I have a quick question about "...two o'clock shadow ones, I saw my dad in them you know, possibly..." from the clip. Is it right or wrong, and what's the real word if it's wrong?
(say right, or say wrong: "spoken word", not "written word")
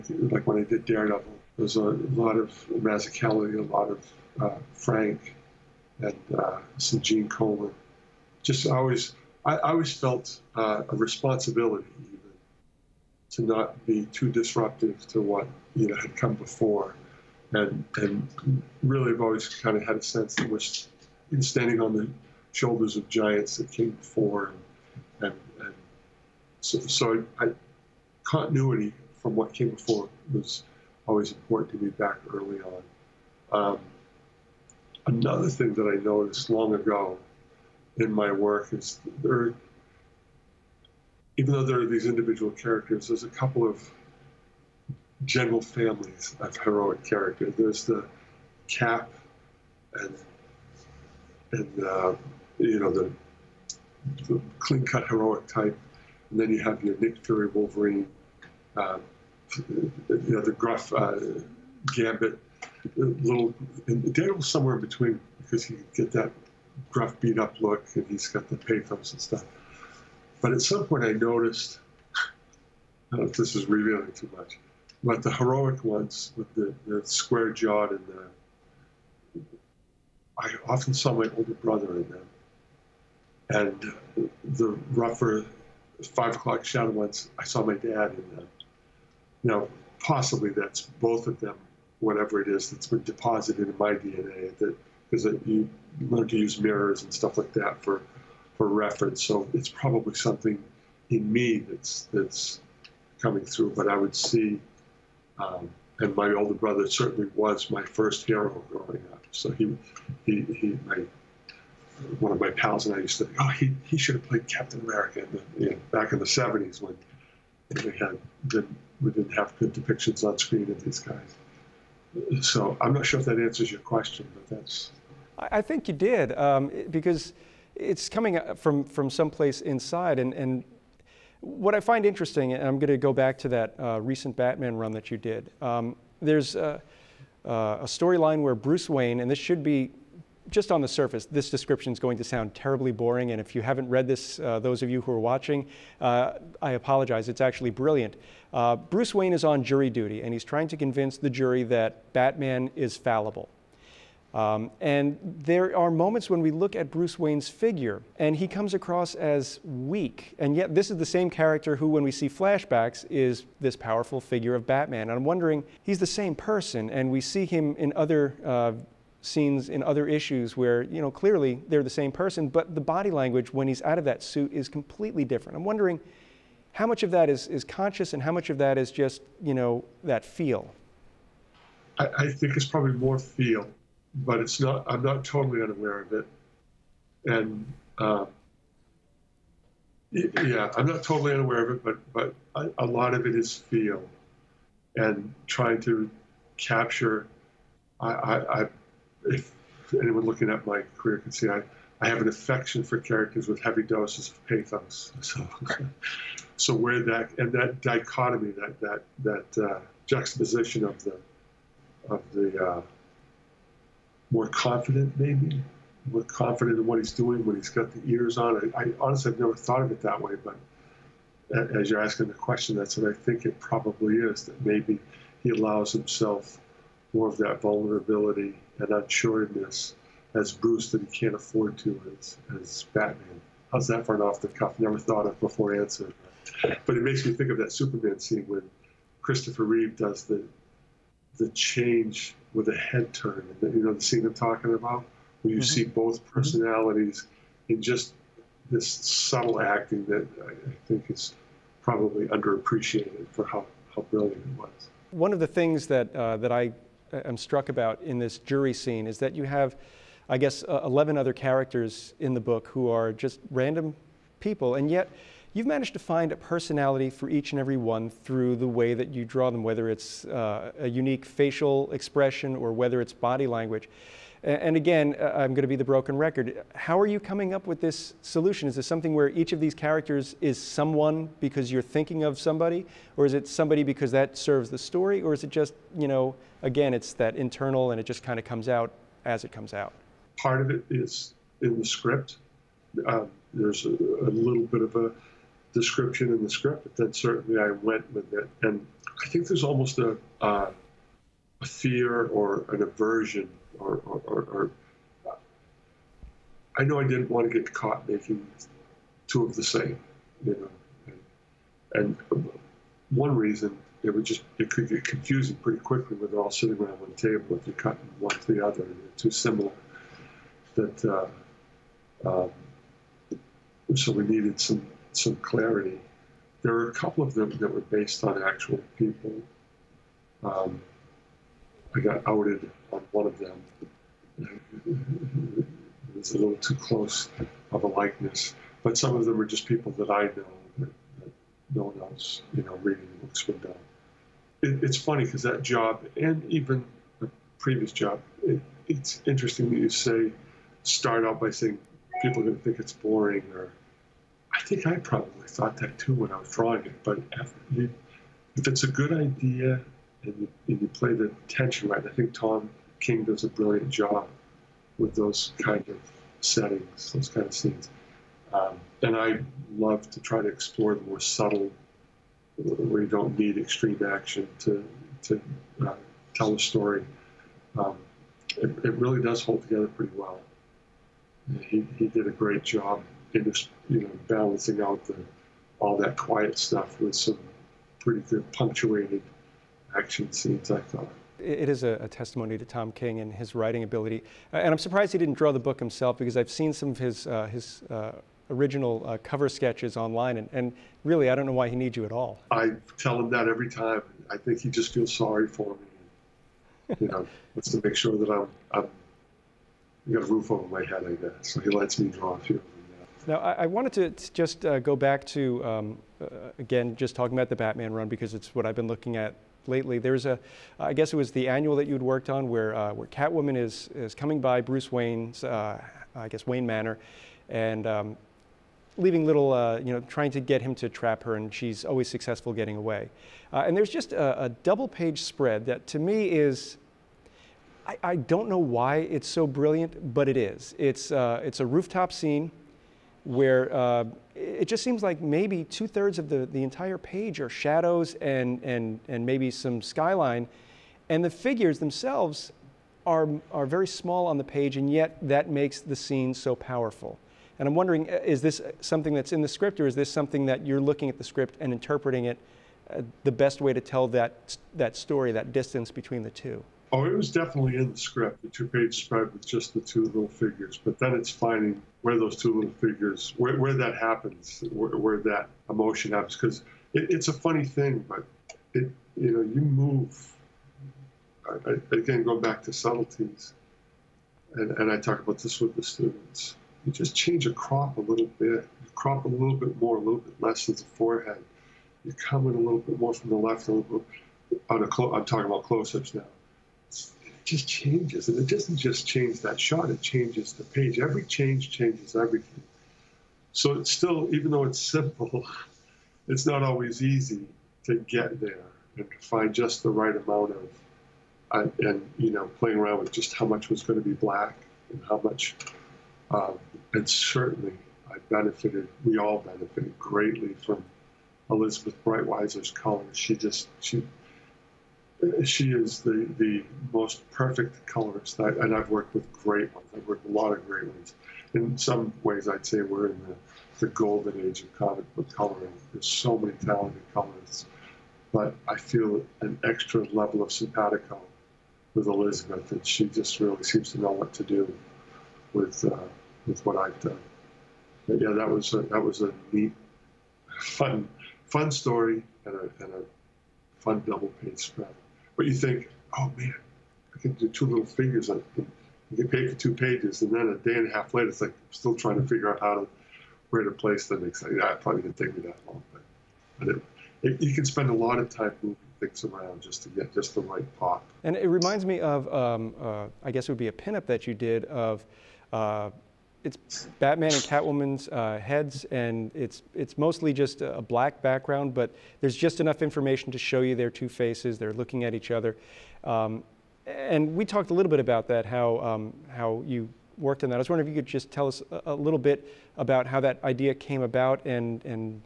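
wrong: "five", not "two".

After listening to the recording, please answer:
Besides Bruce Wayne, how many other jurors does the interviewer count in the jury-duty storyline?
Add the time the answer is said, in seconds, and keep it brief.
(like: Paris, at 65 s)
11, at 260 s.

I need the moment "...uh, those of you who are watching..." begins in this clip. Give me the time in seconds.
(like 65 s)
144 s.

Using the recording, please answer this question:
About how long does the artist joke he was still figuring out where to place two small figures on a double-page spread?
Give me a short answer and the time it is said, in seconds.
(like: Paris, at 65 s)
A day and a half, at 560 s.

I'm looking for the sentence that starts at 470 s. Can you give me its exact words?
But then it's finding where those two little figures, where, where that happens, where, where, that emotion happens.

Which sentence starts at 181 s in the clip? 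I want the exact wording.
I, I think it's probably more feel, but it's not, I'm not totally unaware of it.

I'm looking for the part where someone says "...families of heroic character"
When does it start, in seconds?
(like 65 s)
45 s.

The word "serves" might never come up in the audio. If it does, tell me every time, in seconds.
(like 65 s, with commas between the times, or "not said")
284 s.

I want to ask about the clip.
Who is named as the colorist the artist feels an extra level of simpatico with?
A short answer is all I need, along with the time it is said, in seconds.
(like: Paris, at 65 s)
Elizabeth Breitweiser, at 521 s.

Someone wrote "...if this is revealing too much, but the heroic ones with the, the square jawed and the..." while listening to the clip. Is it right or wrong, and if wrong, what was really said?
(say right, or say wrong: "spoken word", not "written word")
right.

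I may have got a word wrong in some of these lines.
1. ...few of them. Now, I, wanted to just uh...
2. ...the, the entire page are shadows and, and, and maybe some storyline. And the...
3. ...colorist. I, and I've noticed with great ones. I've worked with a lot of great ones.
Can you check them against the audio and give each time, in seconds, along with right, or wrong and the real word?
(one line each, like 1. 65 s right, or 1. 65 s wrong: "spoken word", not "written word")
1. 412 s right
2. 446 s wrong: "skyline", not "storyline"
3. 527 s wrong: "worked", not "noticed".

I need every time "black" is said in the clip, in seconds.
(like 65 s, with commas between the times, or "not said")
514 s, 580 s.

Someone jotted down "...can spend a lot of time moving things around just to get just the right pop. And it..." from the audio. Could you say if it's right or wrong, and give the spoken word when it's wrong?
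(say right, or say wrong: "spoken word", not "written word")
right.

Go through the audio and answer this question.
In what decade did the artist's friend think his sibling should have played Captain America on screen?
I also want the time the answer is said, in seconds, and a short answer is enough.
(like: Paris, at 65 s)
The 70s, at 116 s.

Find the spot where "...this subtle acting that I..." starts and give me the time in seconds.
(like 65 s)
248 s.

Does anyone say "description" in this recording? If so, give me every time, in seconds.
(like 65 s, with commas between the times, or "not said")
141 s, 295 s.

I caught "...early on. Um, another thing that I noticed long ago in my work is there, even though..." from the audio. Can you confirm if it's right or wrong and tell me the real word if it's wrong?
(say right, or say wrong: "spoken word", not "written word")
right.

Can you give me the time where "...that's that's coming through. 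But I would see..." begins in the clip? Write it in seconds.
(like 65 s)
101 s.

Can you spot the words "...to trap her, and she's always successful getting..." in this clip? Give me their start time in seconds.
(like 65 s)
430 s.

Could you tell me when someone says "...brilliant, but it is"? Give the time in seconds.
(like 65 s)
439 s.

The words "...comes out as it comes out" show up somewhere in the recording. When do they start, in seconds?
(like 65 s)
288 s.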